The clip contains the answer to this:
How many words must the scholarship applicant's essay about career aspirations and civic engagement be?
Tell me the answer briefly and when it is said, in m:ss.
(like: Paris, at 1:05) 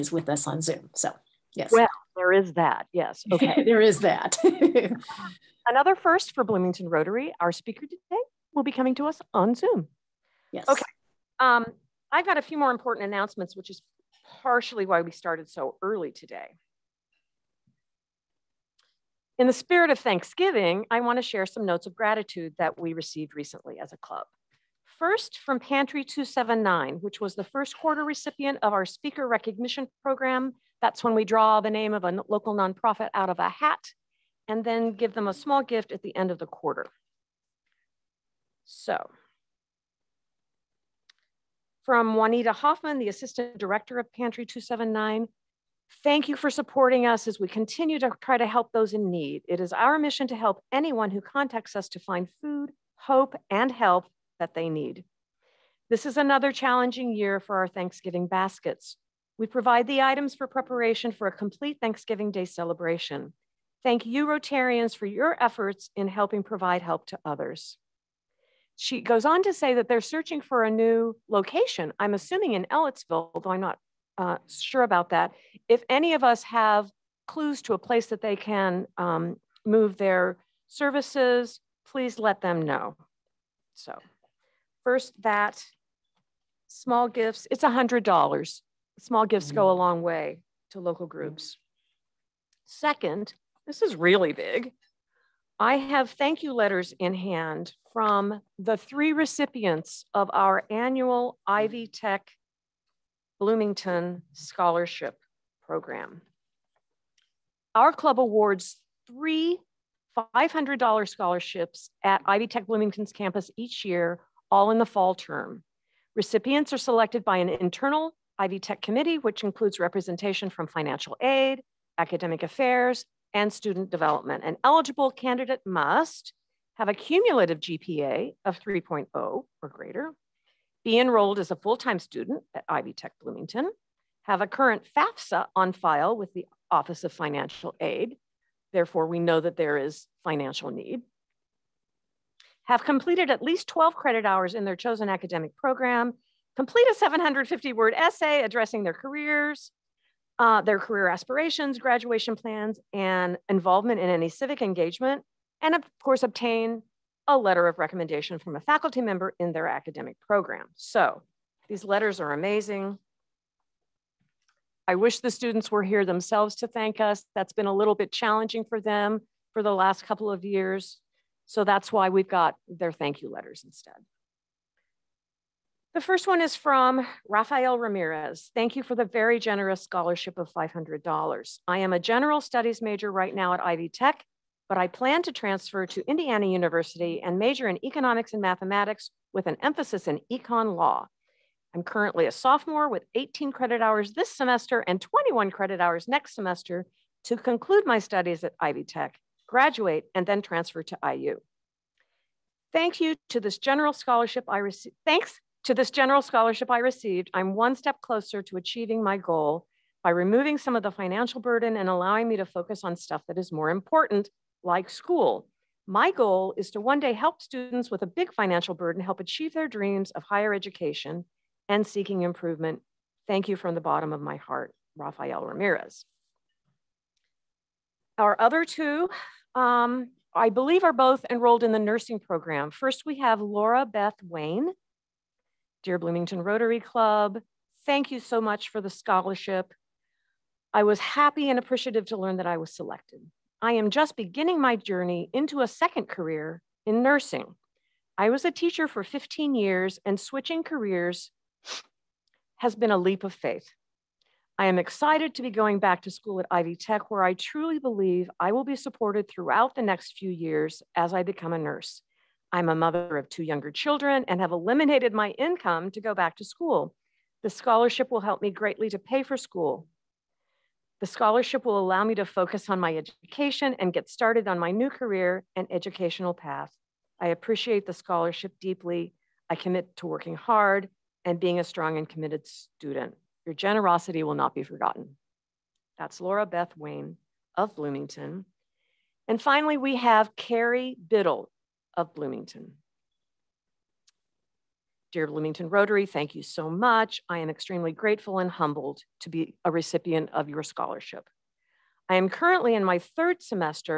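750, at 2:26.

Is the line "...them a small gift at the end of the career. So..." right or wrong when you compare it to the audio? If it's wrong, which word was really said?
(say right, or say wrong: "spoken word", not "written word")
wrong: "quarter", not "career".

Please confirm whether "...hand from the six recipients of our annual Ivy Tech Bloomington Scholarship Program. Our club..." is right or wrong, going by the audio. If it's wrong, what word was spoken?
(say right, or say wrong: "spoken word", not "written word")
wrong: "three", not "six".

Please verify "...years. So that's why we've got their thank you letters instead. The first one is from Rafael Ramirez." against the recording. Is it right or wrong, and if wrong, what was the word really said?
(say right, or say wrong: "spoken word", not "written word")
right.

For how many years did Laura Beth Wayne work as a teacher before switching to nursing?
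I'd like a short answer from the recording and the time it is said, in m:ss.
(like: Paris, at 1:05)
15, at 4:09.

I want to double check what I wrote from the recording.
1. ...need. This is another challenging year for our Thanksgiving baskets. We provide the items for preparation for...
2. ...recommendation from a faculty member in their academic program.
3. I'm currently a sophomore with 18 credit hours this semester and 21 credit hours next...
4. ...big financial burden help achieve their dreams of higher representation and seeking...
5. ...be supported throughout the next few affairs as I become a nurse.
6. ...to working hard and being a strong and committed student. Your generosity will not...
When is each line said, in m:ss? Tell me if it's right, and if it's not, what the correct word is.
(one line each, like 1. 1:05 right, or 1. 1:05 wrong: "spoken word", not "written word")
1. 0:54 right
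2. 2:37 right
3. 3:11 right
4. 3:38 wrong: "education", not "representation"
5. 4:18 wrong: "years", not "affairs"
6. 4:39 right.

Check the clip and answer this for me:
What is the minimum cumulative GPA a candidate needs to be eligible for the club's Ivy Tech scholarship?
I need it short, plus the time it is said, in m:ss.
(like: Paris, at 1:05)
3.0, at 2:08.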